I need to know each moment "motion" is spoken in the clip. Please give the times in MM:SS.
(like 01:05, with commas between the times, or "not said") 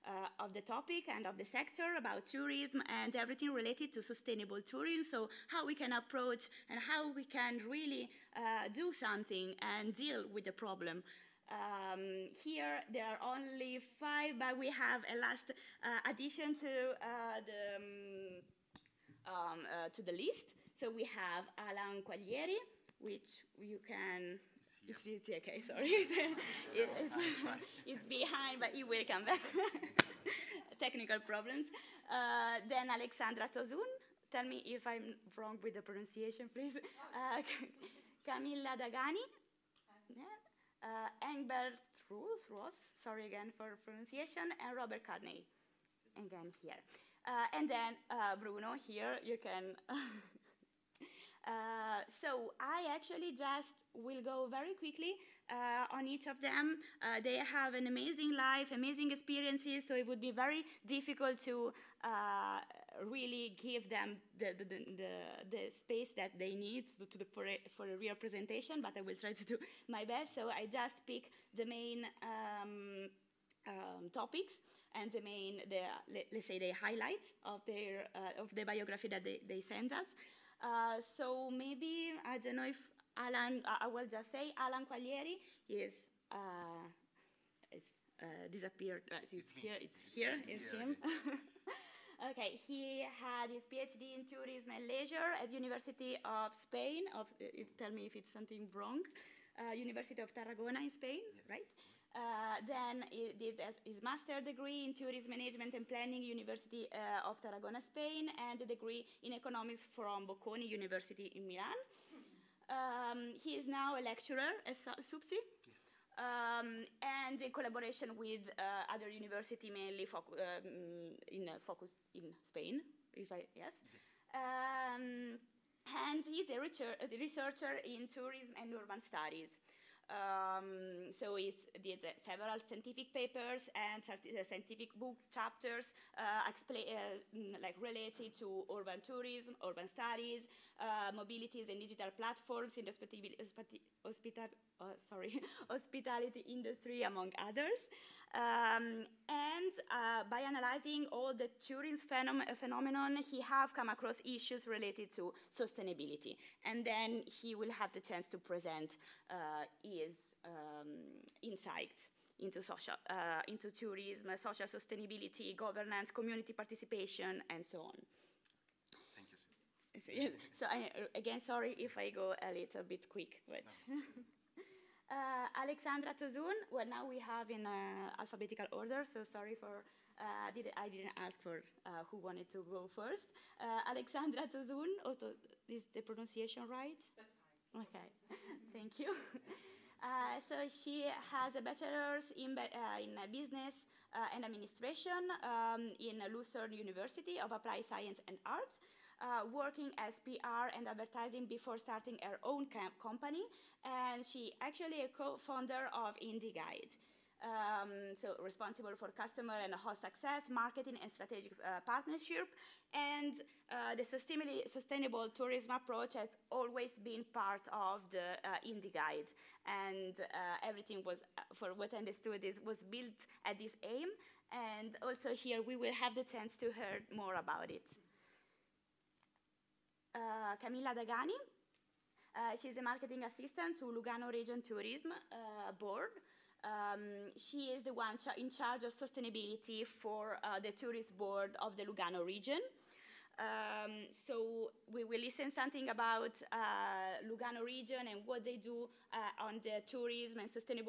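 not said.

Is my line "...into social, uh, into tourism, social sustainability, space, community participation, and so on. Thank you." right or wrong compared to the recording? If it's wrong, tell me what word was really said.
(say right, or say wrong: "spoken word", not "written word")
wrong: "governance", not "space".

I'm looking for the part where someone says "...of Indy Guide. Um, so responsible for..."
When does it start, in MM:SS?
03:25.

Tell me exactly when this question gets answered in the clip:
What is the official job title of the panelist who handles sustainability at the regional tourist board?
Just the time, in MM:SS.
03:52.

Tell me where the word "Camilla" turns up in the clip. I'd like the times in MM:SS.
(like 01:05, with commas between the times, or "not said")
00:38, 03:50.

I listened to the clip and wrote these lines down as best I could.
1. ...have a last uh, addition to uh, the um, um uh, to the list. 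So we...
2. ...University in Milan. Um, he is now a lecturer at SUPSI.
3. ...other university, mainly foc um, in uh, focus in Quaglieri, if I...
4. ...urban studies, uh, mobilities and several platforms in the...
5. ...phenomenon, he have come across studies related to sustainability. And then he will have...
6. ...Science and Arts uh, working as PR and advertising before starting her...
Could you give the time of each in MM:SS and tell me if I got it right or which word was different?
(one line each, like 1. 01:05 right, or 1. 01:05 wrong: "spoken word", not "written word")
1. 00:14 right
2. 01:50 right
3. 01:58 wrong: "Spain", not "Quaglieri"
4. 02:19 wrong: "digital", not "several"
5. 02:32 wrong: "issues", not "studies"
6. 03:17 right.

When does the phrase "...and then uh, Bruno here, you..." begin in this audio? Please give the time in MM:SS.
00:47.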